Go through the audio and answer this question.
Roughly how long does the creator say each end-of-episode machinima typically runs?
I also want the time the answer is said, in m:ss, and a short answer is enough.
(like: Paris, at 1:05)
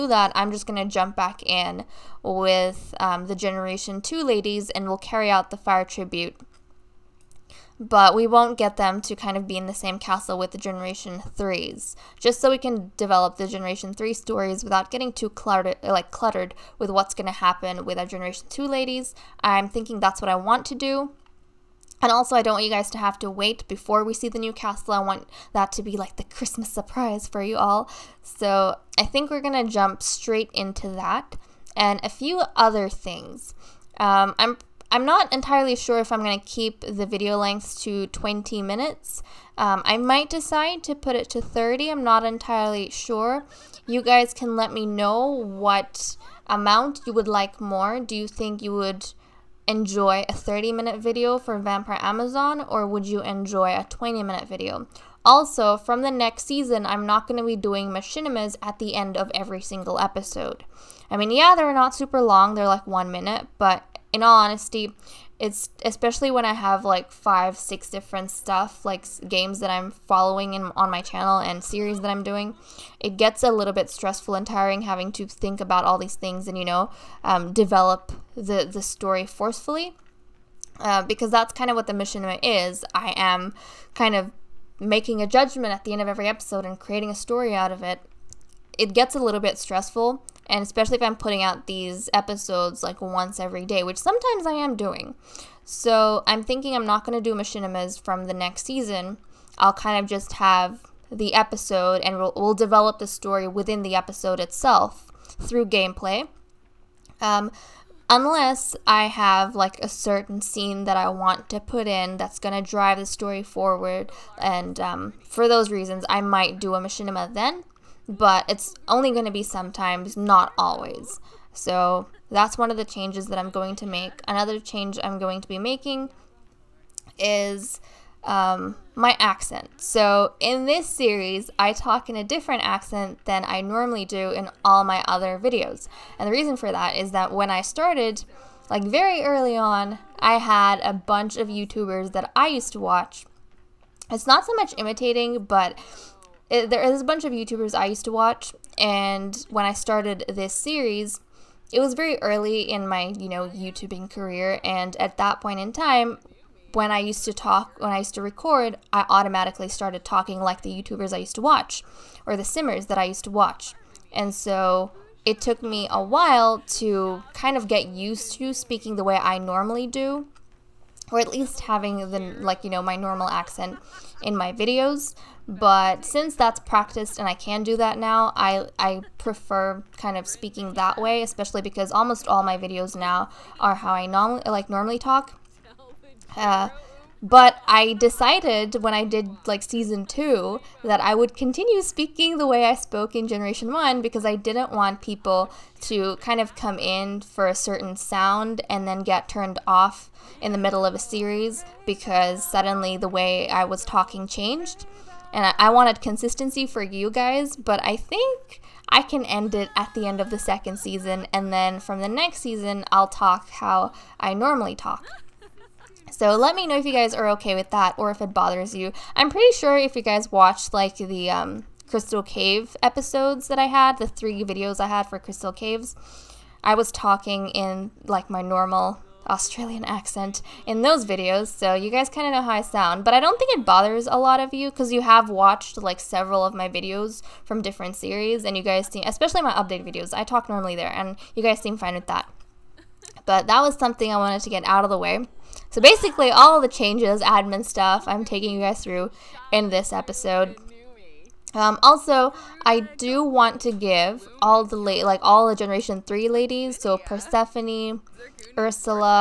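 one minute, at 1:02.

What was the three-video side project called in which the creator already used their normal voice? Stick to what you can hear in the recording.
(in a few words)
Crystal Caves.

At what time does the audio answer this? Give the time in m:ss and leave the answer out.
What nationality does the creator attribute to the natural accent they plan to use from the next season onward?
3:49.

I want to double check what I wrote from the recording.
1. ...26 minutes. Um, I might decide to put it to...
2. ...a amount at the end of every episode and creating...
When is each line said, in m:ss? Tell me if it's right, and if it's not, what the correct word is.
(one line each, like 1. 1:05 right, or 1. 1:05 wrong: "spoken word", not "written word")
1. 0:38 wrong: "20", not "26"
2. 1:25 wrong: "judgment", not "amount".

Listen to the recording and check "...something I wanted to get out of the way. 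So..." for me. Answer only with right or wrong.
right.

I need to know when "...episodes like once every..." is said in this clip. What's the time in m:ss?
1:32.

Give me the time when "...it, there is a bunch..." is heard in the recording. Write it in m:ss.
2:26.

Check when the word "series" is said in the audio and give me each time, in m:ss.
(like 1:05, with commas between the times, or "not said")
1:11, 2:10, 2:30, 3:20, 3:57.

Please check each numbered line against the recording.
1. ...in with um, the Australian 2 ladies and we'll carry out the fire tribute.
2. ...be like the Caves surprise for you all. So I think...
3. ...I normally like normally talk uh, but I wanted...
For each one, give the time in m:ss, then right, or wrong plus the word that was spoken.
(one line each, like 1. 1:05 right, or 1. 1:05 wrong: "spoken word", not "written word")
1. 0:01 wrong: "Generation", not "Australian"
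2. 0:25 wrong: "Christmas", not "Caves"
3. 3:03 wrong: "decided", not "wanted".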